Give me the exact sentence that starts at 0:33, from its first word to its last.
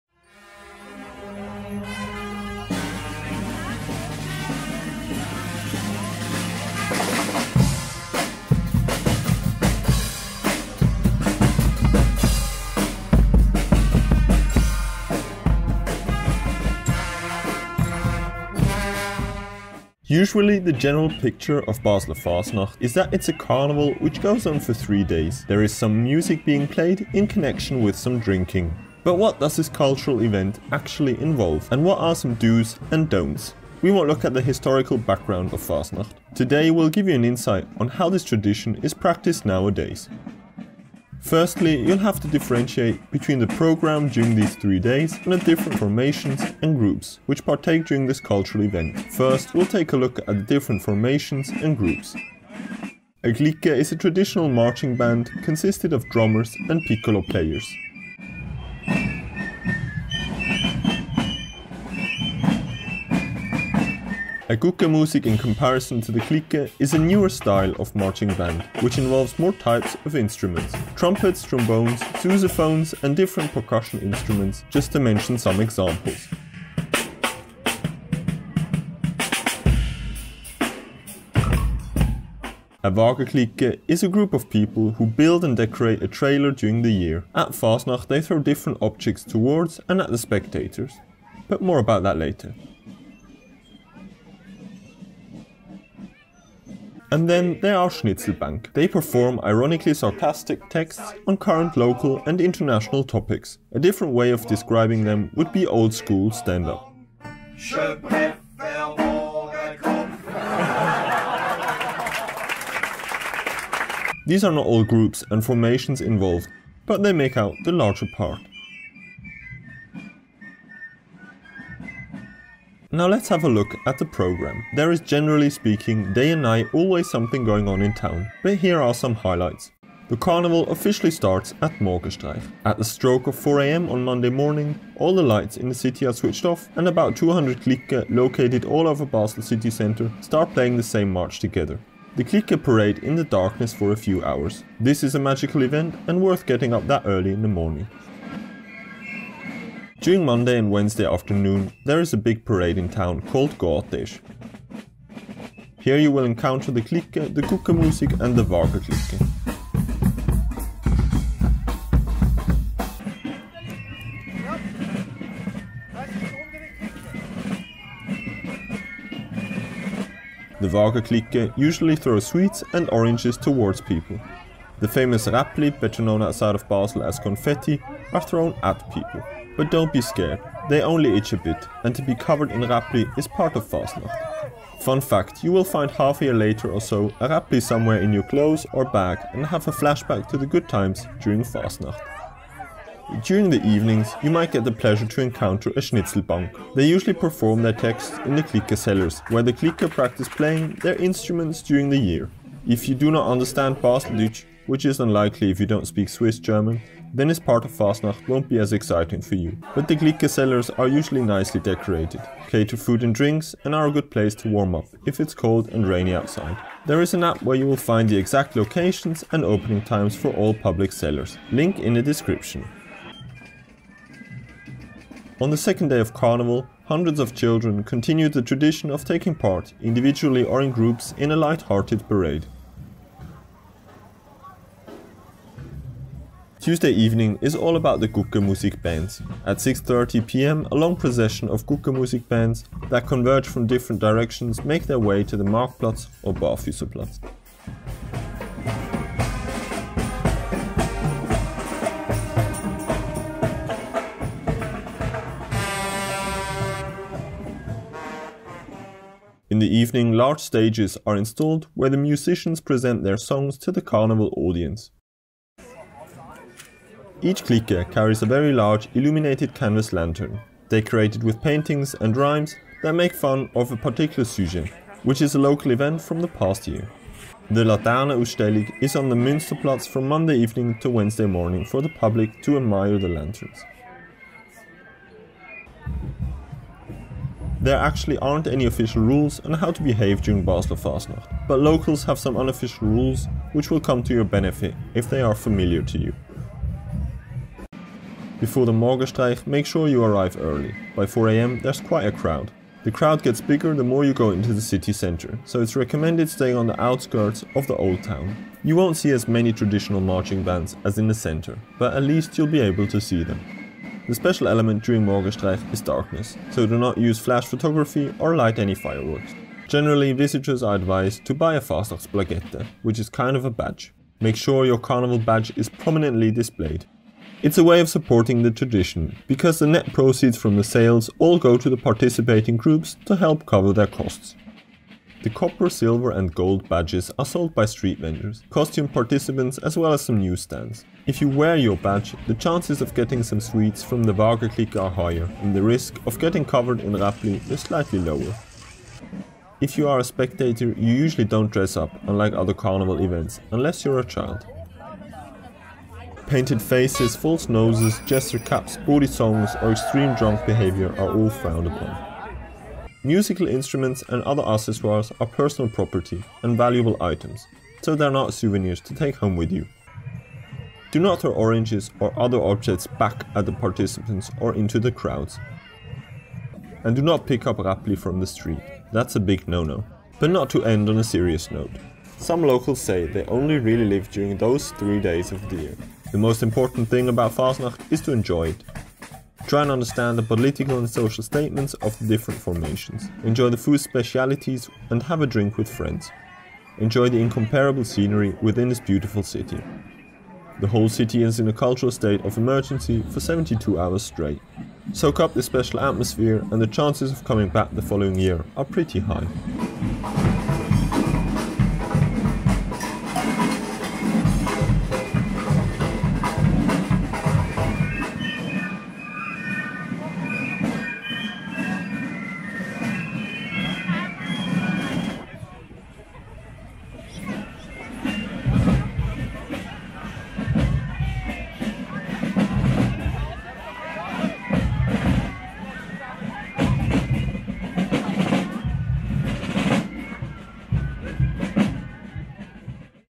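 We will look at the historical background of Fasnacht.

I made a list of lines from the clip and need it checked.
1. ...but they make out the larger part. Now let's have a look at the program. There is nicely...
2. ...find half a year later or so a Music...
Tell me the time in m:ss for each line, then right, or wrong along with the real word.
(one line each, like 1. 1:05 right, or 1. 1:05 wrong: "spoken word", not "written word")
1. 1:56 wrong: "generally", not "nicely"
2. 3:05 wrong: "Räppli", not "Music".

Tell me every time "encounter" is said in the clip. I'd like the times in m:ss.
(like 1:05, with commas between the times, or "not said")
2:36, 3:15.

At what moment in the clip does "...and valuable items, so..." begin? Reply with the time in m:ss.
6:06.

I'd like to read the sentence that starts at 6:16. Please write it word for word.
And do not pick up Räppli from the street, that's a big no-no.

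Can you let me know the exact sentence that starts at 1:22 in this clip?
A Wagerklique is a group of people who build and decorate a trailer during the year.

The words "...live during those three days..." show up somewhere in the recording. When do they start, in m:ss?
6:23.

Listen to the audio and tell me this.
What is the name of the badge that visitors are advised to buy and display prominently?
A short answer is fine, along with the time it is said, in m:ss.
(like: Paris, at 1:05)
Fastnachtsplagette, at 5:21.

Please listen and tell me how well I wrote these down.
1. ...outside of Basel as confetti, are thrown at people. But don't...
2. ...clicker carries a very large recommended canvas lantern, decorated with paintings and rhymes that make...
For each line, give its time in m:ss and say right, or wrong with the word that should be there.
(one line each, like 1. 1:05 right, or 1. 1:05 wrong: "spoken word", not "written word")
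1. 2:56 right
2. 4:27 wrong: "illuminated", not "recommended".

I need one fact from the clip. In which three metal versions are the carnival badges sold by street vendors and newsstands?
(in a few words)
copper, silver and gold.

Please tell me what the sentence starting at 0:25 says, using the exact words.
There is some music being played in connection with some drinking.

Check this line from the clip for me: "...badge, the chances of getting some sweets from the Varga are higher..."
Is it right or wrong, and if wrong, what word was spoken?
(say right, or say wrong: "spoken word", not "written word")
wrong: "Wagerklick", not "Varga".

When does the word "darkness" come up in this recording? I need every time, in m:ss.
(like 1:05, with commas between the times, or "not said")
2:23, 5:15.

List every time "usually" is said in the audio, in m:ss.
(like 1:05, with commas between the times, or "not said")
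0:20, 2:51, 3:16, 3:30, 5:50.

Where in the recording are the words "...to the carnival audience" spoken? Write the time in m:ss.
4:23.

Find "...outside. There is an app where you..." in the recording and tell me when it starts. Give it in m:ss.
3:36.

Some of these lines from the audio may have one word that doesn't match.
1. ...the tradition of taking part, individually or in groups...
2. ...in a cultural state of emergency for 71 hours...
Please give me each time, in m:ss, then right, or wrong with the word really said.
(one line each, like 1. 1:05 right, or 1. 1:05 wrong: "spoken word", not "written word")
1. 3:48 right
2. 6:41 wrong: "72", not "71".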